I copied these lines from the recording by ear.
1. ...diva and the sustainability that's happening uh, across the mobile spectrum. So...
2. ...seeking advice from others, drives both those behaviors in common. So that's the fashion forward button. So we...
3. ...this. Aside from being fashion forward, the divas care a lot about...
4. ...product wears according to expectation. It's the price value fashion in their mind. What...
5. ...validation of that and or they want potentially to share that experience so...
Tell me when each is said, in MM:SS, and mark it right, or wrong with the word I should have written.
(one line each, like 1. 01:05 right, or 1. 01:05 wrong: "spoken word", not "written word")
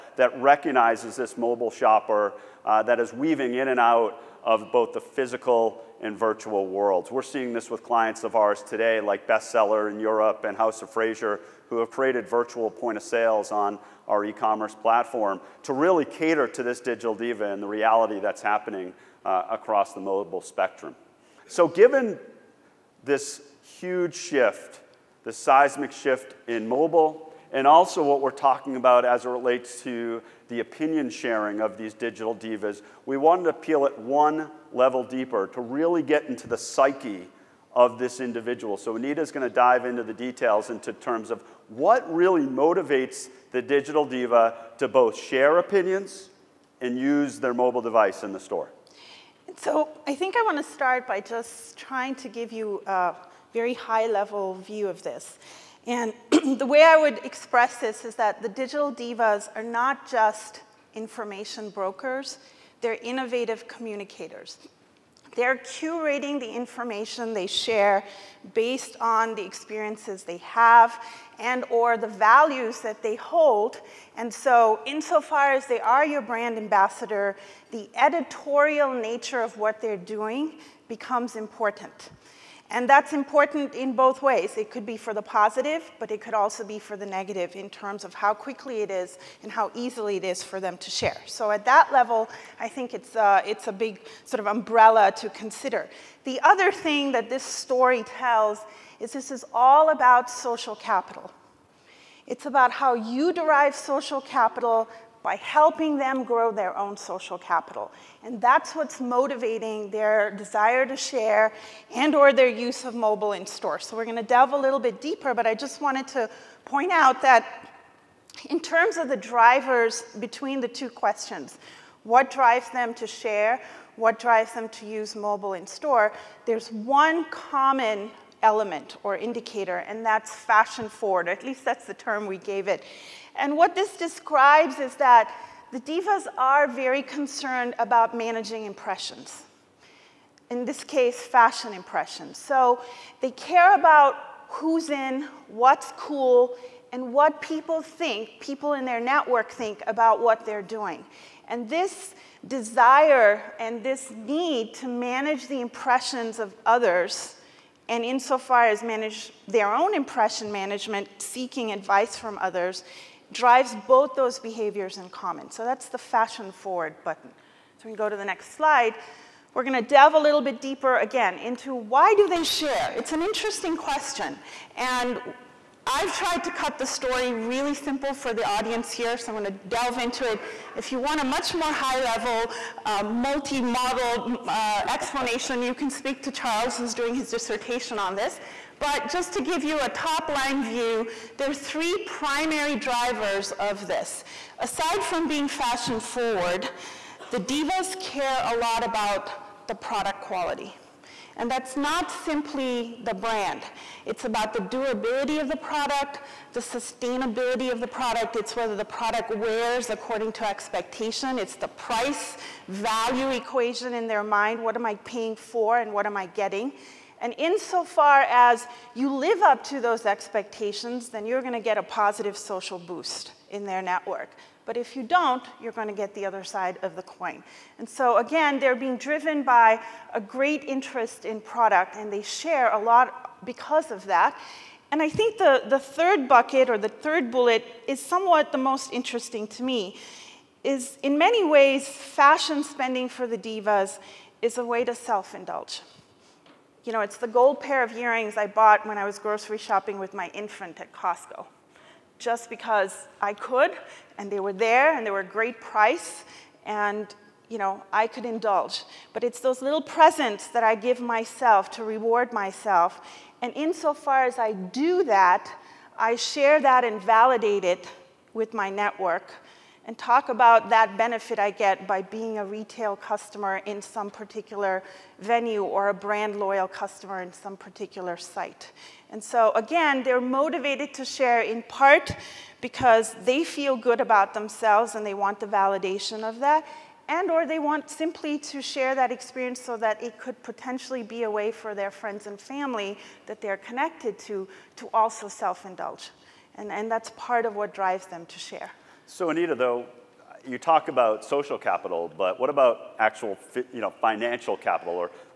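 1. 00:17 wrong: "reality", not "sustainability"
2. 02:41 right
3. 03:13 right
4. 03:28 wrong: "equation", not "fashion"
5. 04:45 wrong: "simply", not "potentially".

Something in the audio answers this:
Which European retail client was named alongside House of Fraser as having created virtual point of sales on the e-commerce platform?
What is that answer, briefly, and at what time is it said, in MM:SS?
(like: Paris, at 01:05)
Bestseller, at 00:09.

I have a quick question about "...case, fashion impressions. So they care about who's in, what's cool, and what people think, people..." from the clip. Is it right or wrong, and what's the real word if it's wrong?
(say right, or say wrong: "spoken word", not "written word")
right.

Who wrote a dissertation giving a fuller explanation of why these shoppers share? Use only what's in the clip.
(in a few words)
Charles.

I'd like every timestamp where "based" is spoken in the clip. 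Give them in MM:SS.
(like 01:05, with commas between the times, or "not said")
01:08.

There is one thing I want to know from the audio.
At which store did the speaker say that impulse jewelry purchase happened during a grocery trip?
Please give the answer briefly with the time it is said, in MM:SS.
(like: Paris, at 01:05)
Costco, at 04:10.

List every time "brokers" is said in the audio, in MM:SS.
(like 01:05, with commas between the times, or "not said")
01:01.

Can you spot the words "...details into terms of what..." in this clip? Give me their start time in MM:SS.
00:40.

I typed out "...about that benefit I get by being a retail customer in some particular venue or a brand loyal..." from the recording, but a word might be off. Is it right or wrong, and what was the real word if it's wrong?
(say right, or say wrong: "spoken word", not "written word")
right.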